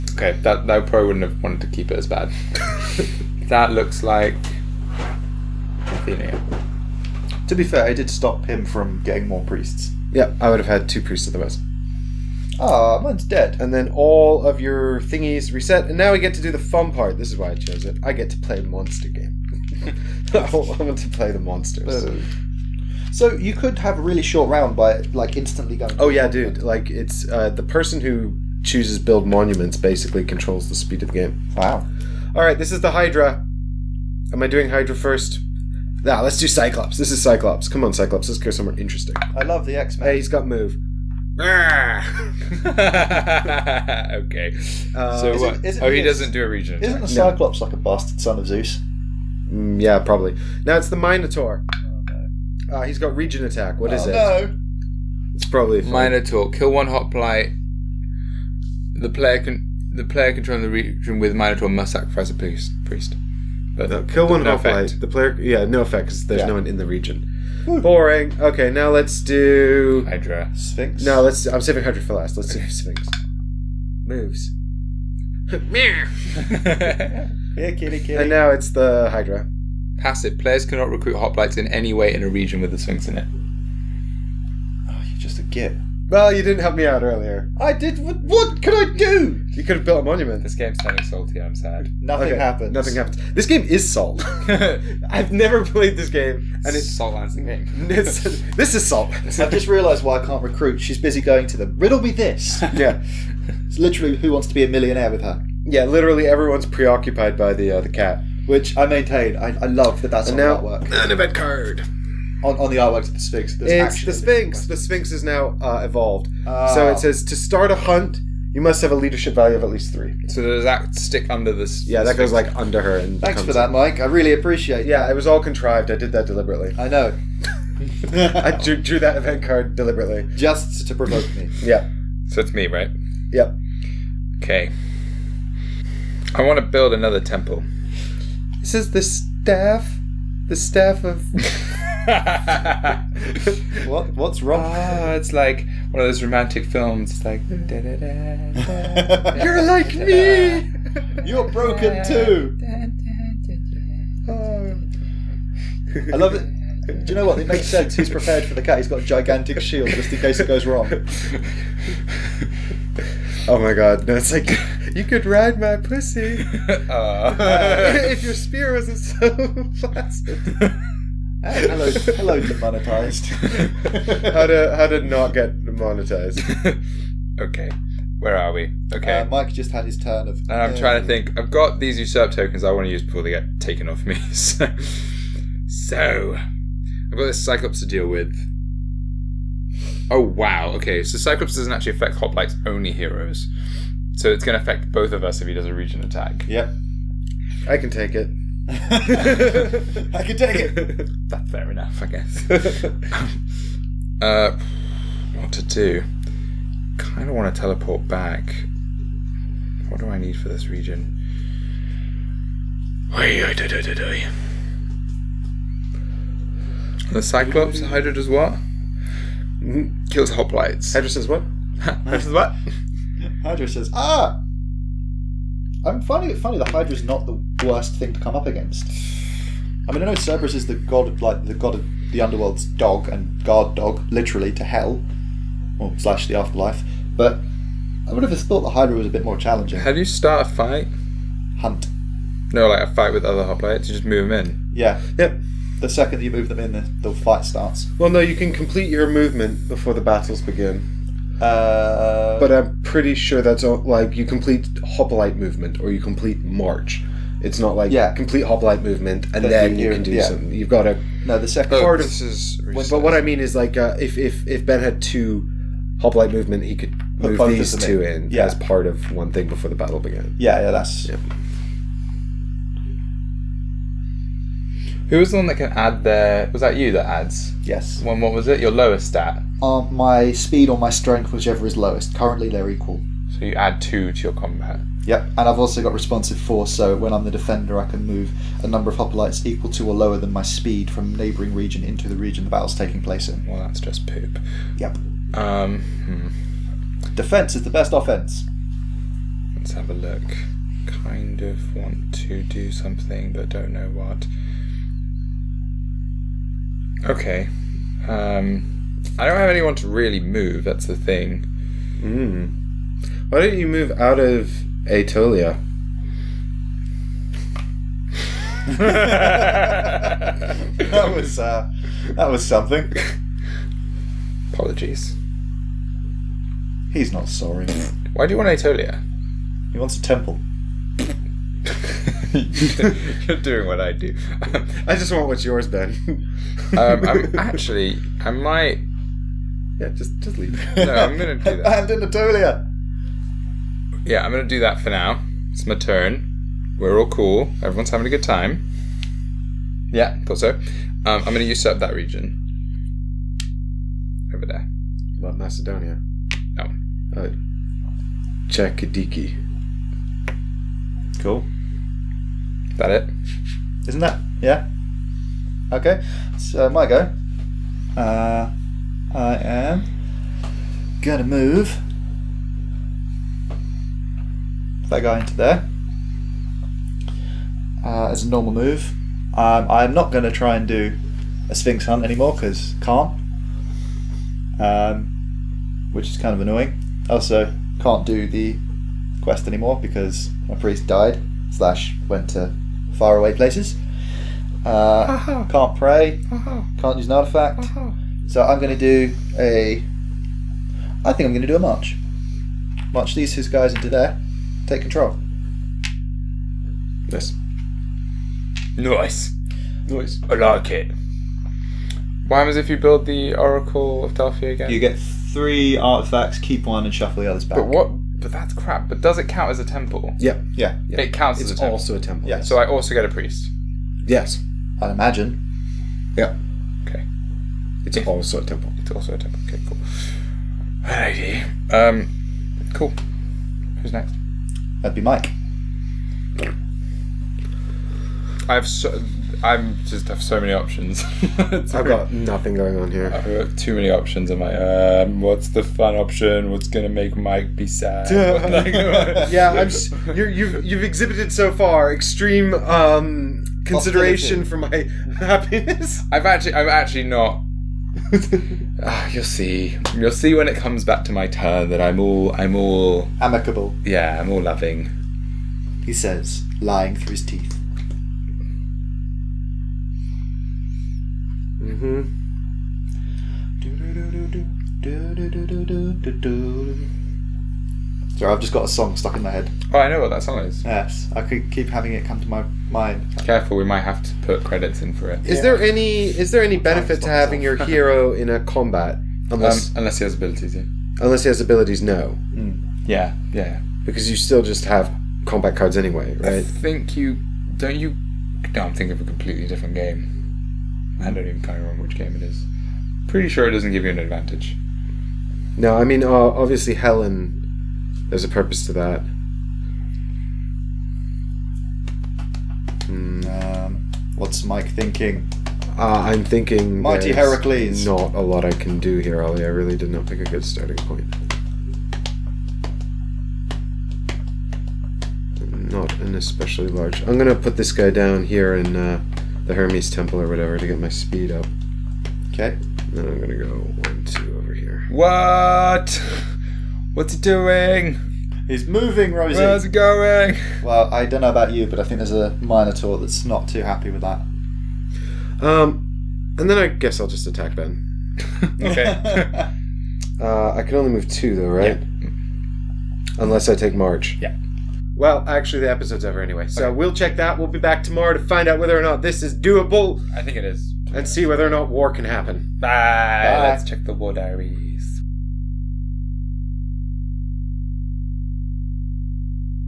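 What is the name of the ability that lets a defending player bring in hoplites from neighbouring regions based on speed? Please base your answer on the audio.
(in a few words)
responsive force.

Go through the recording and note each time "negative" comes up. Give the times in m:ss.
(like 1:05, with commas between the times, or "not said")
not said.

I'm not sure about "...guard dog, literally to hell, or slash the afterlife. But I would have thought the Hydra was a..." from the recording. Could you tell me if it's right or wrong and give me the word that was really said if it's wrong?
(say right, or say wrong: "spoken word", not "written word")
right.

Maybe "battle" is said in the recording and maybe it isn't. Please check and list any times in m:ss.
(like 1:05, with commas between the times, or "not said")
4:10, 4:29, 4:52.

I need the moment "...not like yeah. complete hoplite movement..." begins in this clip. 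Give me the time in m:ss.
4:17.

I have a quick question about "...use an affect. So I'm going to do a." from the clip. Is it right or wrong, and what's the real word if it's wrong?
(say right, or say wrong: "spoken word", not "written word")
wrong: "artifact", not "affect".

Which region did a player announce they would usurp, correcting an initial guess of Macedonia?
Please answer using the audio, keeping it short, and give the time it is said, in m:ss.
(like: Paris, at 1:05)
Chalkidiki, at 5:58.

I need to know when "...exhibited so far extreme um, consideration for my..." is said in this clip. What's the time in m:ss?
7:30.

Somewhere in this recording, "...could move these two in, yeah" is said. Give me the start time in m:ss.
4:26.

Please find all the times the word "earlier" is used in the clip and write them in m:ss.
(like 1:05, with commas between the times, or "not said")
1:27.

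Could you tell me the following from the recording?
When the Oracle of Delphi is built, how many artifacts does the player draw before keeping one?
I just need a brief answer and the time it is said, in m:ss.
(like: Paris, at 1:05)
3, at 6:55.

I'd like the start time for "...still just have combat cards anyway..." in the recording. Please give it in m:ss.
8:14.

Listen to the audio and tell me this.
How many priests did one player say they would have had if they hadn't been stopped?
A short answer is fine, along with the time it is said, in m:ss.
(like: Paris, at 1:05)
2, at 0:10.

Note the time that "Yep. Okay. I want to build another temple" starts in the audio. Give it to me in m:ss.
2:13.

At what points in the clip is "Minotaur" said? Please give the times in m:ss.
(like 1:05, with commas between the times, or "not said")
0:50, 0:55, 1:01, 9:02.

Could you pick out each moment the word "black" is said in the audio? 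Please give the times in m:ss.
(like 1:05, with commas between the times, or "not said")
not said.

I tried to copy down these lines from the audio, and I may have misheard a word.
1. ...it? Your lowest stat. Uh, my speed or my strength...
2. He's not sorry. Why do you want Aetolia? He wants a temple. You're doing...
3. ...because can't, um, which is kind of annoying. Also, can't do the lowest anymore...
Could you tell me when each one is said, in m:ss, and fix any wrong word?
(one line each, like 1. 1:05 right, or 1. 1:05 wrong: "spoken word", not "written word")
1. 4:38 right
2. 5:26 right
3. 6:22 wrong: "quest", not "lowest".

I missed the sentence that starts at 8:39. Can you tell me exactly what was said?
I really did not pick a good starting point.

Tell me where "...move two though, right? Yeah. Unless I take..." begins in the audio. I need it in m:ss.
9:10.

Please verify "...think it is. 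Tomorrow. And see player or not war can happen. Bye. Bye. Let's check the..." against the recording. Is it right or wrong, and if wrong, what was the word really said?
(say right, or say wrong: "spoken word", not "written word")
wrong: "whether", not "player".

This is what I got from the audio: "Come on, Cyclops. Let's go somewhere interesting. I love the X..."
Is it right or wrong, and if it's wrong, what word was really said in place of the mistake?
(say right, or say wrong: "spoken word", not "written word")
right.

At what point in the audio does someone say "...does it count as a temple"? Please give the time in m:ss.
6:59.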